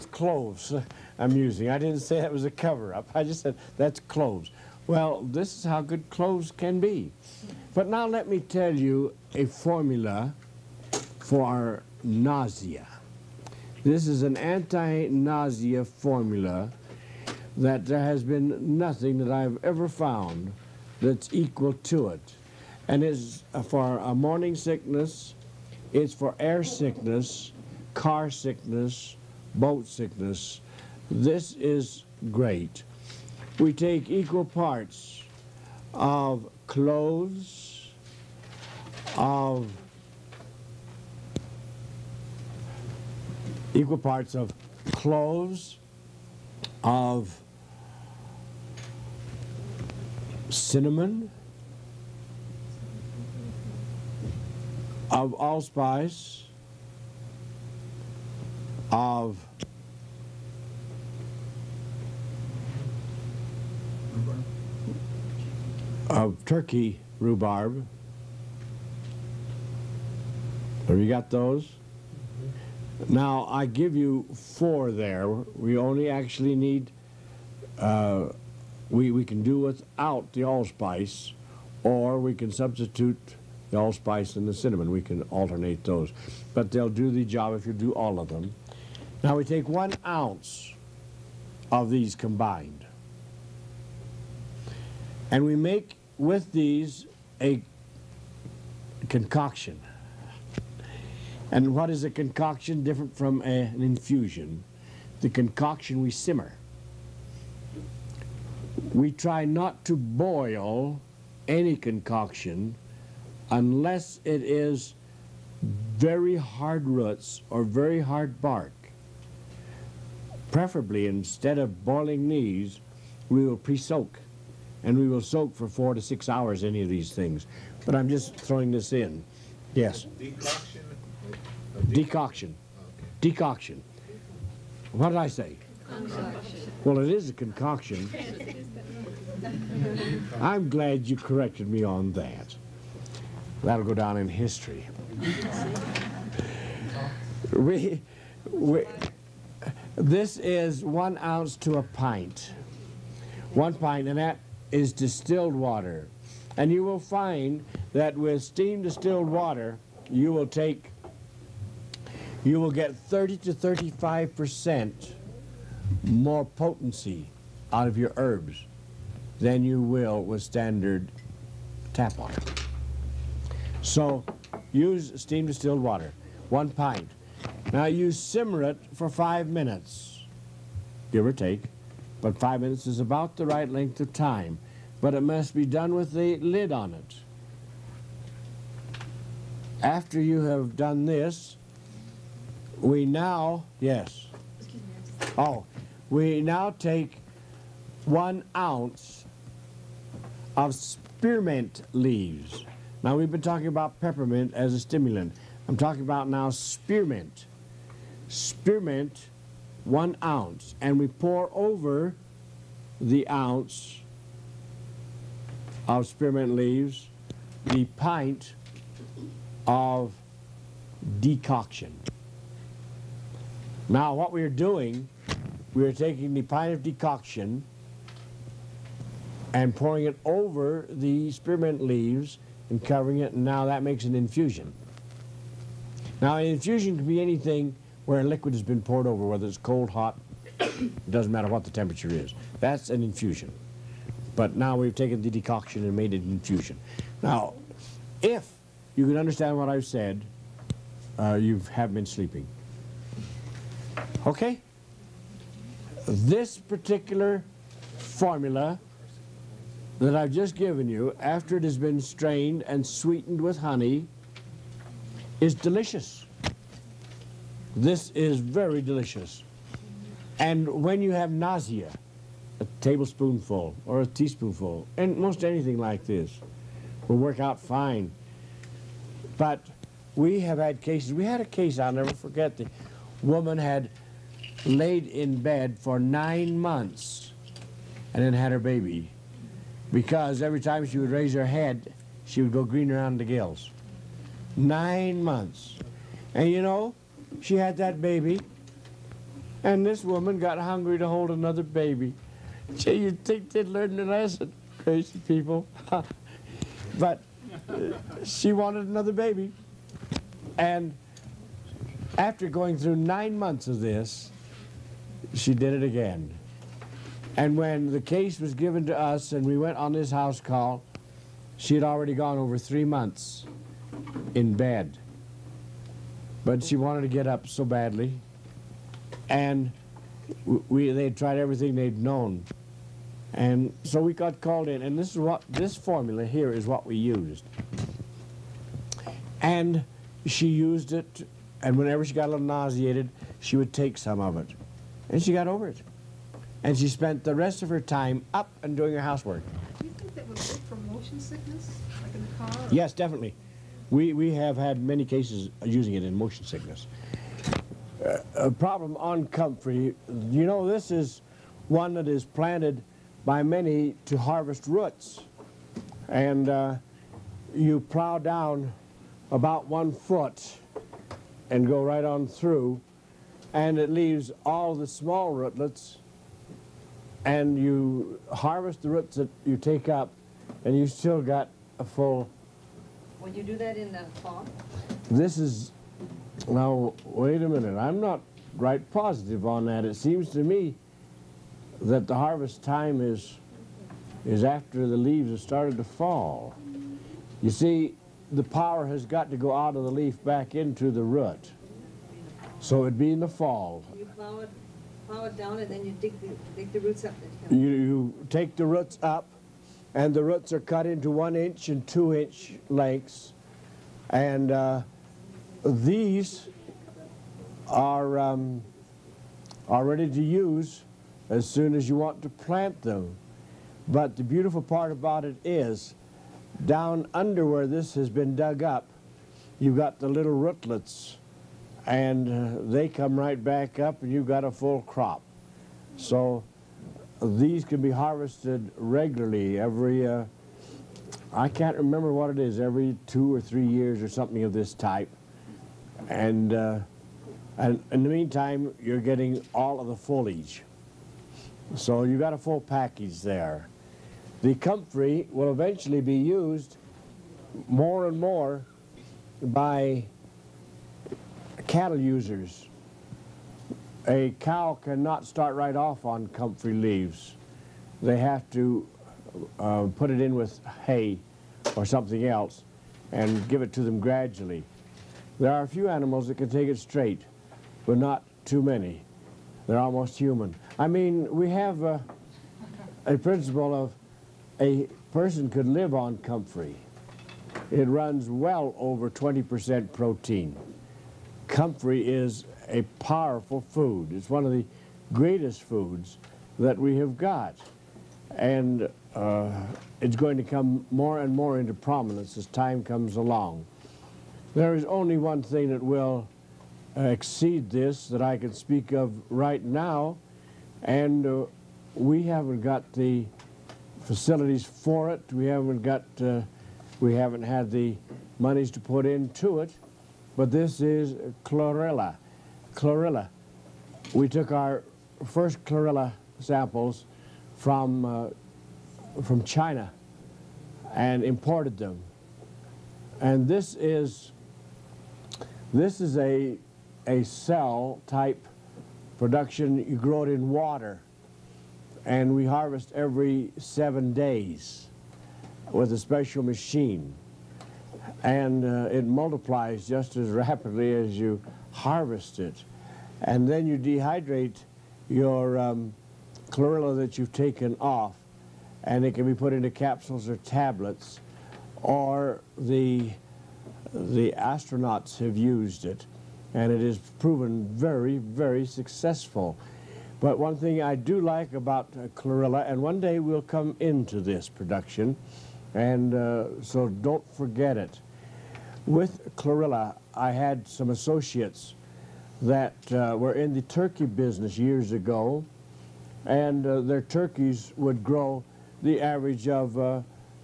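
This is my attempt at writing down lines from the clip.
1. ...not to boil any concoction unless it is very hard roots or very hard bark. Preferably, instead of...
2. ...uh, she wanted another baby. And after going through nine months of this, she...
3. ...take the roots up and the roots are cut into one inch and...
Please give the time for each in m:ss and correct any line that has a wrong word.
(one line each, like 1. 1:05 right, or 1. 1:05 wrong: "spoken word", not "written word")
1. 1:49 right
2. 5:07 right
3. 6:48 right.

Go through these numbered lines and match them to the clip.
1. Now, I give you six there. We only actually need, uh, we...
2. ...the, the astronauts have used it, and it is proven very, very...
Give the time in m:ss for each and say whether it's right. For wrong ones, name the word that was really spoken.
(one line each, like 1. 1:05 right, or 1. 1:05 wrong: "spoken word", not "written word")
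1. 1:13 wrong: "four", not "six"
2. 9:22 right.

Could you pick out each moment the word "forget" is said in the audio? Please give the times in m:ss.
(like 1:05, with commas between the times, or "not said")
4:42, 9:37.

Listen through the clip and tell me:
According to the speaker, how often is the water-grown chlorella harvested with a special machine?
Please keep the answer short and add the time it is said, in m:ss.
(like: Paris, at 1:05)
Every 7 days, at 9:02.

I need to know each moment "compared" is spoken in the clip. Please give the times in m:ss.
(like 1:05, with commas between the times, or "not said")
not said.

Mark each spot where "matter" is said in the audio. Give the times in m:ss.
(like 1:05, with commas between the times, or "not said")
4:01.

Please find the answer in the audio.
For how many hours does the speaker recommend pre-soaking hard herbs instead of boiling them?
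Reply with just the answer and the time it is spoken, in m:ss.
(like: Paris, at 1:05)
4 to 6, at 2:05.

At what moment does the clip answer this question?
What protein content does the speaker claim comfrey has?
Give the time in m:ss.
8:08.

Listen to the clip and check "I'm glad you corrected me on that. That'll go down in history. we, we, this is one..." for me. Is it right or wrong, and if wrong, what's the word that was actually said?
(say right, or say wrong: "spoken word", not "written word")
right.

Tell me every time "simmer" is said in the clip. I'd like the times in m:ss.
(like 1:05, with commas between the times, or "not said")
1:46, 2:58.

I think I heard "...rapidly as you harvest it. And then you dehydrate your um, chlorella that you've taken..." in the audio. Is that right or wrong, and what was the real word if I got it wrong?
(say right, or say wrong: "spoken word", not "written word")
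right.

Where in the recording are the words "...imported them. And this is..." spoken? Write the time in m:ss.
8:51.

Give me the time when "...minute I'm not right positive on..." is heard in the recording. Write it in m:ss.
6:27.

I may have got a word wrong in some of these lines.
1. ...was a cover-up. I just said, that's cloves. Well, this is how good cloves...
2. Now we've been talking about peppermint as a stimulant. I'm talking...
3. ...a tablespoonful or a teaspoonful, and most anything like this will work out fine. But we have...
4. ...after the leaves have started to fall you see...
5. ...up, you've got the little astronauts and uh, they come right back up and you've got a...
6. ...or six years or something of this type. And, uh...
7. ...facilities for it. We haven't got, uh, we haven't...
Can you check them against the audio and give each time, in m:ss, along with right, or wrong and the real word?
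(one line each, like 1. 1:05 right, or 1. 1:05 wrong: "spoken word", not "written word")
1. 0:02 right
2. 3:23 right
3. 4:32 right
4. 6:34 right
5. 7:08 wrong: "rootlets", not "astronauts"
6. 7:23 wrong: "three", not "six"
7. 8:34 right.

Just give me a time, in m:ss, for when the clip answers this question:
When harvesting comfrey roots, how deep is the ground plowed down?
6:09.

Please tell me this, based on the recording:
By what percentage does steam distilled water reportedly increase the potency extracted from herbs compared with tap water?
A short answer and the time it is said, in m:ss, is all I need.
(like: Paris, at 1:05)
30 to 35%, at 2:42.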